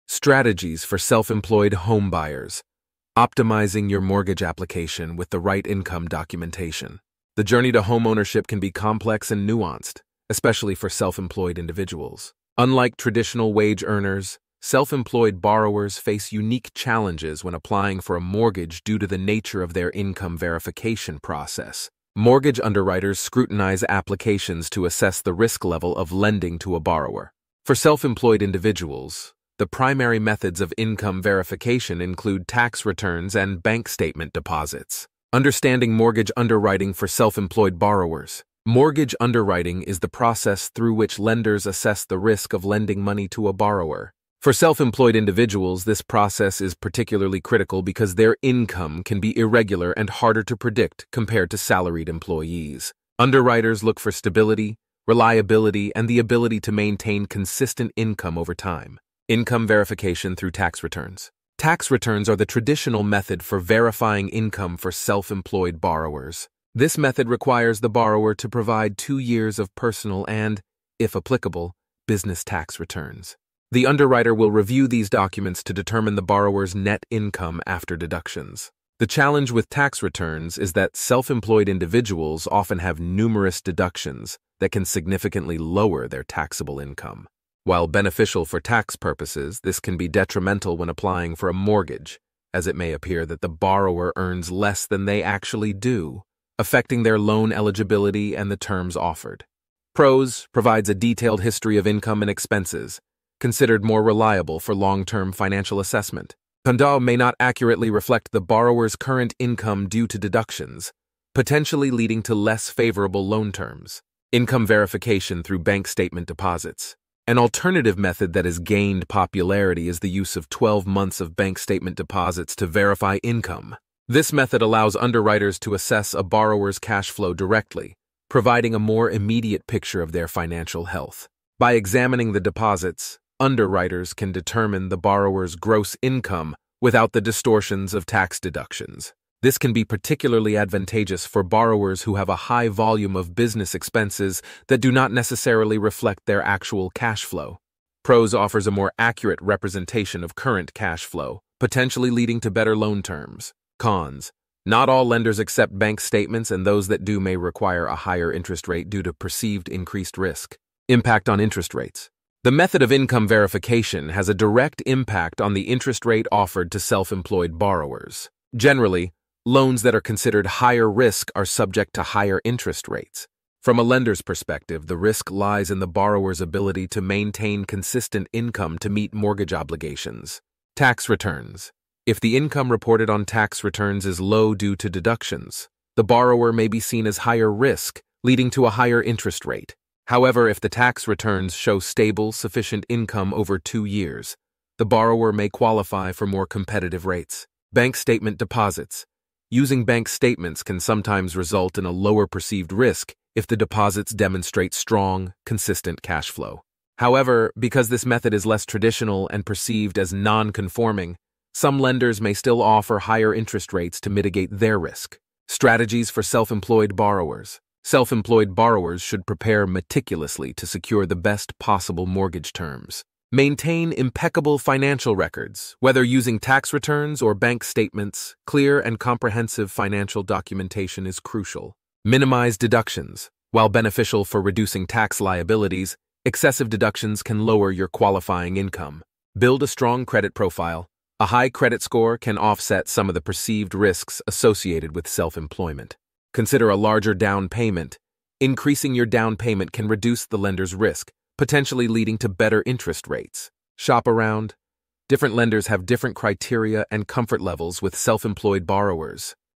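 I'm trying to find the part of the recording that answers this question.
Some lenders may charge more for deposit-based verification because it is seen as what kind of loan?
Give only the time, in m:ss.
3:30.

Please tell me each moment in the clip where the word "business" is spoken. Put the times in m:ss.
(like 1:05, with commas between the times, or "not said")
1:12, 2:23.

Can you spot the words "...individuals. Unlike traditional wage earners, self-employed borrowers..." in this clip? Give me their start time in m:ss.
0:11.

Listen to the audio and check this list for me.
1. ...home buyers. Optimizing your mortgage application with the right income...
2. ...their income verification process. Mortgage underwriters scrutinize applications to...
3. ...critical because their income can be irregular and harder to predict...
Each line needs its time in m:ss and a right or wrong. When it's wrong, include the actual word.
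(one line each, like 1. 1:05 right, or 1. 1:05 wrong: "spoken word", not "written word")
1. 0:01 right
2. 0:19 right
3. 0:47 right.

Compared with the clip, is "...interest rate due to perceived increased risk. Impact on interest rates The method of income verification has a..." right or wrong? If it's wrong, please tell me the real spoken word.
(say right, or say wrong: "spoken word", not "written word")
right.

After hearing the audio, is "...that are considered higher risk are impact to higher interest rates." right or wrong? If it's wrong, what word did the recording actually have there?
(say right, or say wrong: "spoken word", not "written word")
wrong: "subject", not "impact".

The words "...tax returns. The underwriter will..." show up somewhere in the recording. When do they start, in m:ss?
1:12.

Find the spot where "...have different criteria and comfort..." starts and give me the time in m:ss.
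4:15.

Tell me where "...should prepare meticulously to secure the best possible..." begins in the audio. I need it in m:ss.
3:39.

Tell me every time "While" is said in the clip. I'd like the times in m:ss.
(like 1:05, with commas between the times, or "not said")
1:27, 3:53.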